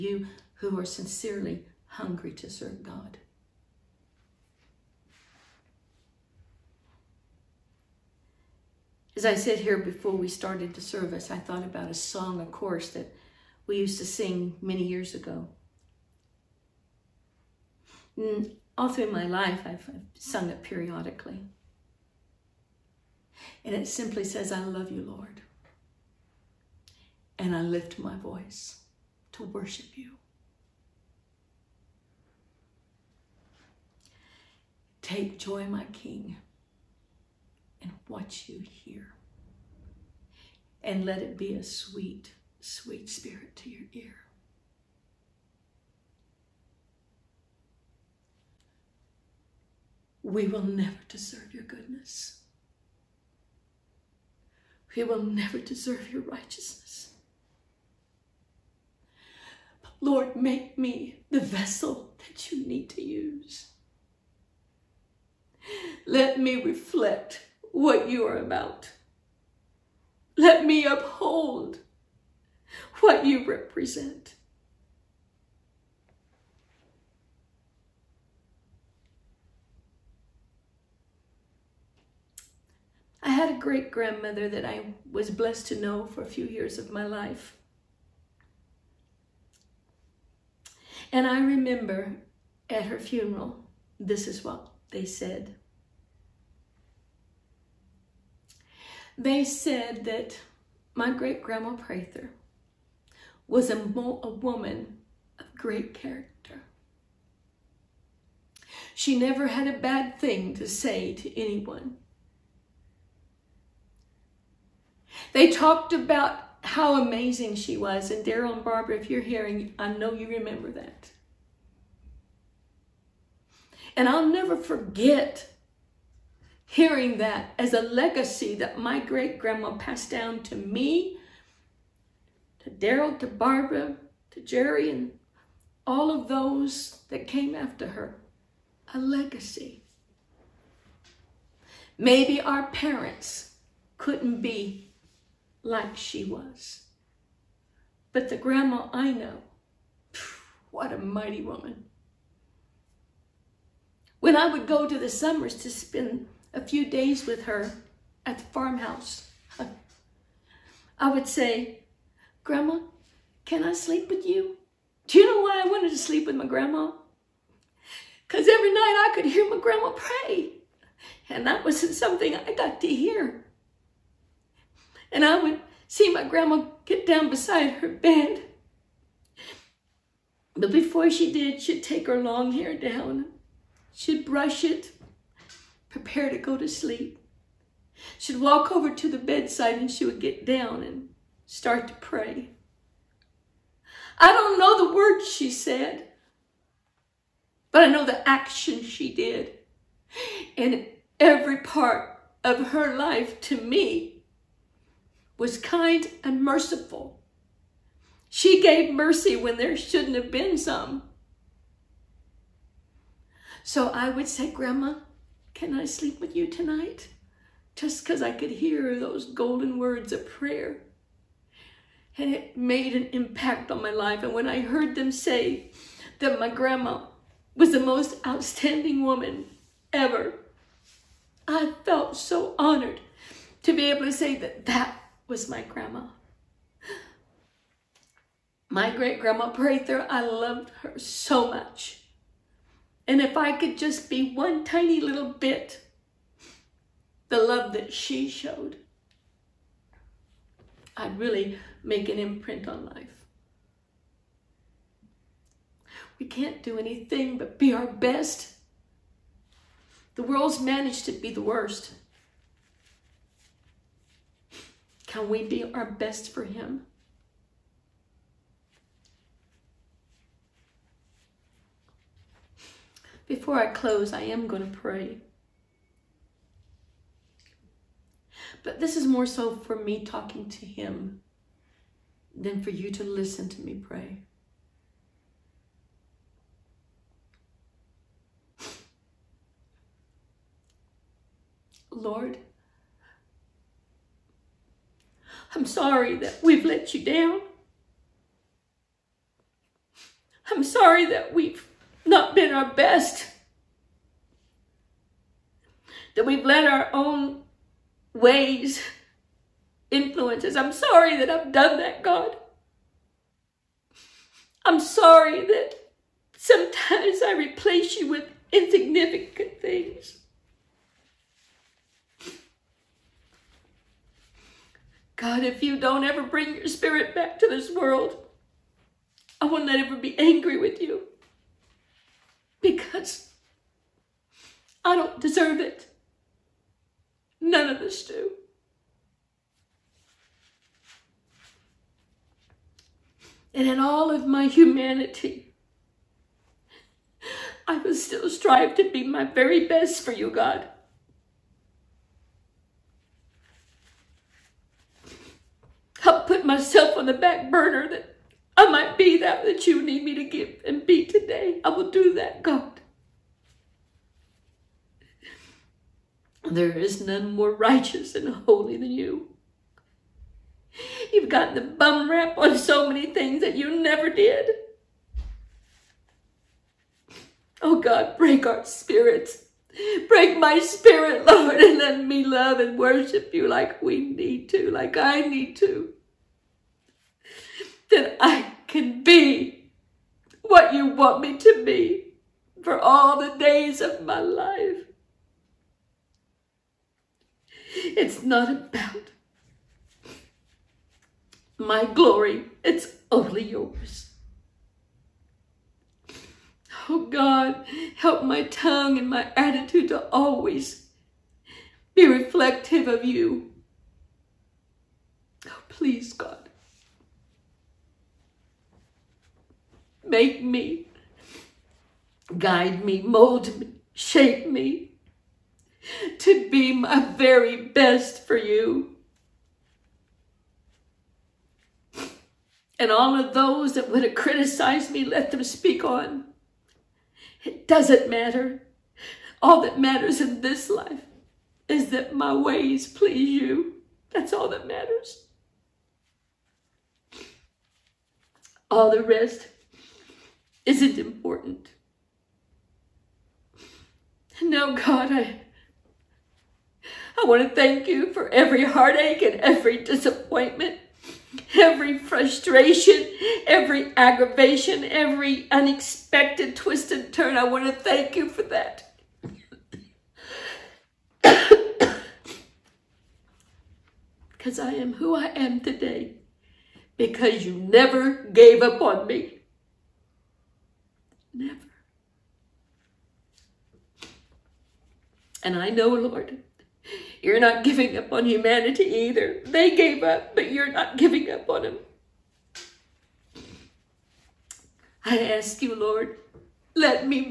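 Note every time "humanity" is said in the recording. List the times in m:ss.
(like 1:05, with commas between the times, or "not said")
5:44, 8:08.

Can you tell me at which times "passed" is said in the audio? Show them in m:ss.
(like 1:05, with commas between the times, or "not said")
2:09.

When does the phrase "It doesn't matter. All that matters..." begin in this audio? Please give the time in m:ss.
7:17.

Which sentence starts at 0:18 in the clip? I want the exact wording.
And mm, all through my life, I've sung it periodically.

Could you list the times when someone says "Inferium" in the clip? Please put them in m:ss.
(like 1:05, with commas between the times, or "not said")
not said.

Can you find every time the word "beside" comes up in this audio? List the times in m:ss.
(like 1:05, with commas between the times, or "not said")
2:57.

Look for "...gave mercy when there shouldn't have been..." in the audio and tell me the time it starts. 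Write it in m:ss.
3:28.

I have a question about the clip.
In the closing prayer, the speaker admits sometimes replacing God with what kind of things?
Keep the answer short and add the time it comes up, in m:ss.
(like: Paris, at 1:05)
insignificant things, at 5:18.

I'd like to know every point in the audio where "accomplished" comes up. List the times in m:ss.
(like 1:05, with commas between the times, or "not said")
not said.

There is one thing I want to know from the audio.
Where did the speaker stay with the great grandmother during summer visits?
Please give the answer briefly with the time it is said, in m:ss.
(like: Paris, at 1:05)
the farmhouse, at 2:38.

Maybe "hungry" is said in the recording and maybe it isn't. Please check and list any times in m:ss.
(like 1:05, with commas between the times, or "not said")
0:01.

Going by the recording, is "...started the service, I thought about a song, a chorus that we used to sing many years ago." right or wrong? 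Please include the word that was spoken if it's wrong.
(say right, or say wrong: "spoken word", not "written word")
right.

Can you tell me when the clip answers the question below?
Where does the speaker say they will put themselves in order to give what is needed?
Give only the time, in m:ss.
5:57.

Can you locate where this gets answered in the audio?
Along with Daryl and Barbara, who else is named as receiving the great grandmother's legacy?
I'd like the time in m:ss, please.
2:14.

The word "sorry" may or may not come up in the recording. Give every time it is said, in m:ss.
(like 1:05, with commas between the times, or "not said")
4:55, 5:00, 5:10, 5:14.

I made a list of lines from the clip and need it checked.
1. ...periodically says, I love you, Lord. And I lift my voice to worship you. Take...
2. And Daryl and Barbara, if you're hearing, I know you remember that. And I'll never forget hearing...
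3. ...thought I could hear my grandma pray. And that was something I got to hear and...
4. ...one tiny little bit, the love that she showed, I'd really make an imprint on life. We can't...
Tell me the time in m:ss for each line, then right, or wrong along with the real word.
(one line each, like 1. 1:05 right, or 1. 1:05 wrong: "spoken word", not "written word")
1. 0:23 wrong: "simply", not "periodically"
2. 1:58 right
3. 2:48 wrong: "night", not "thought"
4. 4:04 right.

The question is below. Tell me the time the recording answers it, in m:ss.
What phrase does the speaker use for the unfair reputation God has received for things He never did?
6:11.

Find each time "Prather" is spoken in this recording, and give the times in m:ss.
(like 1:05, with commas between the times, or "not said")
1:41, 3:59.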